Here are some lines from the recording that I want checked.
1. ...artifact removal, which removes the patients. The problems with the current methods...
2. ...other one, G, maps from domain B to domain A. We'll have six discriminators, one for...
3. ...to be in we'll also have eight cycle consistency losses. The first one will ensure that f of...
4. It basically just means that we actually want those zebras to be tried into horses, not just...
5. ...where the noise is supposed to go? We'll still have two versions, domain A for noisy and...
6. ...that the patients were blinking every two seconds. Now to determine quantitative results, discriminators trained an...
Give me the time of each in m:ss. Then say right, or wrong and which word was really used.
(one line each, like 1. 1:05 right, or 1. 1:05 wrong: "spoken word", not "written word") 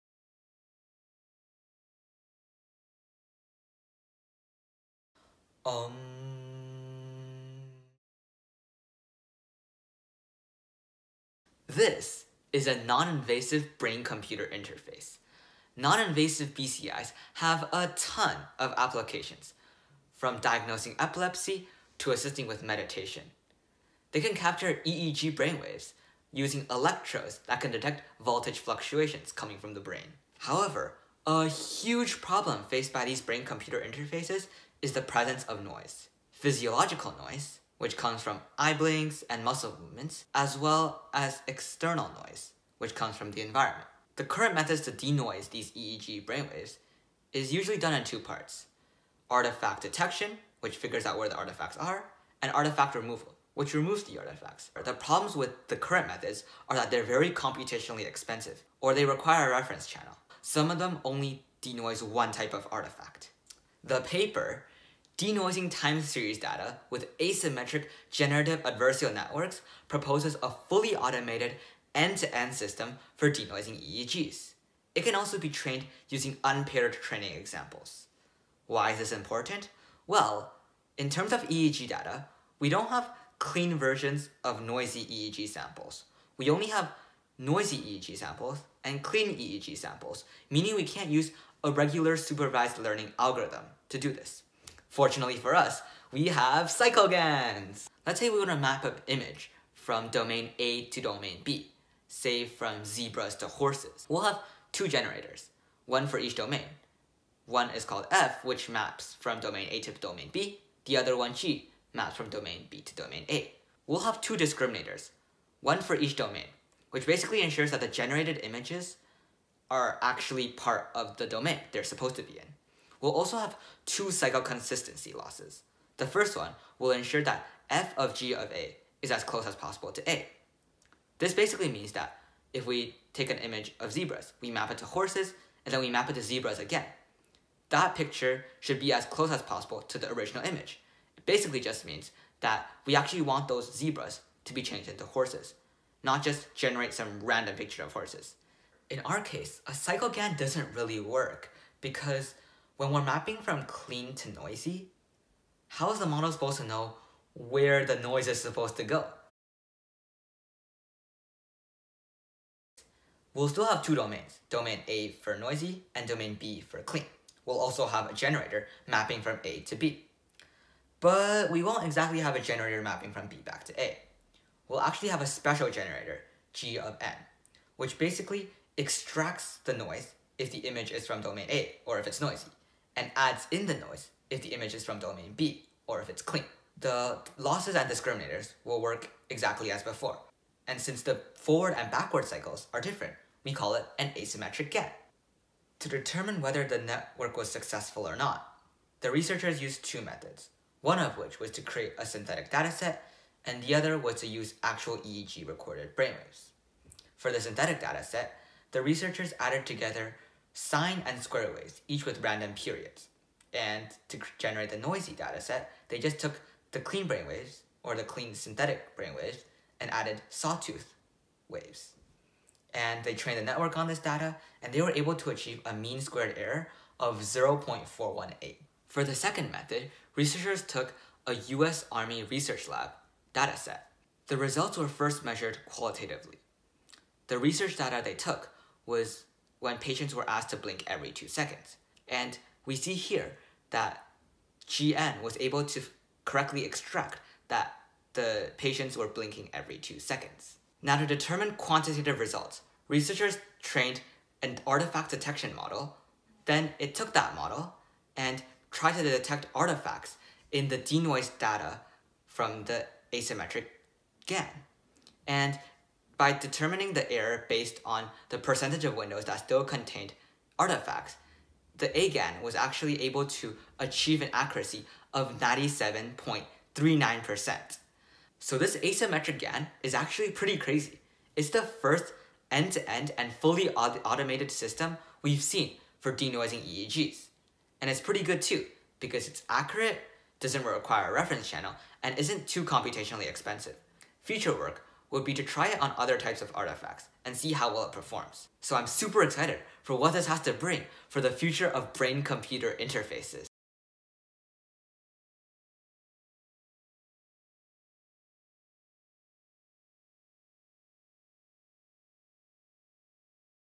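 1. 0:52 wrong: "artifacts", not "patients"
2. 1:50 wrong: "two", not "six"
3. 2:02 wrong: "two", not "eight"
4. 2:21 wrong: "changed", not "tried"
5. 2:37 wrong: "domains", not "versions"
6. 4:07 wrong: "researchers", not "discriminators".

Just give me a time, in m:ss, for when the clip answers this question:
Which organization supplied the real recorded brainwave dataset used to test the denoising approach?
3:51.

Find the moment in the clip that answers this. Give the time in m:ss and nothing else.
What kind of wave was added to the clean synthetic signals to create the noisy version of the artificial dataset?
3:40.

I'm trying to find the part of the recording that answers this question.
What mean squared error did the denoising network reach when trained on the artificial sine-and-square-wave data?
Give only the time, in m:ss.
3:47.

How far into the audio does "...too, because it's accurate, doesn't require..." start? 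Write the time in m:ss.
4:48.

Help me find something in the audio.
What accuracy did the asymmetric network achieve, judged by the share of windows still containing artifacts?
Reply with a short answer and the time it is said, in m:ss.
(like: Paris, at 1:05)
97.39%, at 4:35.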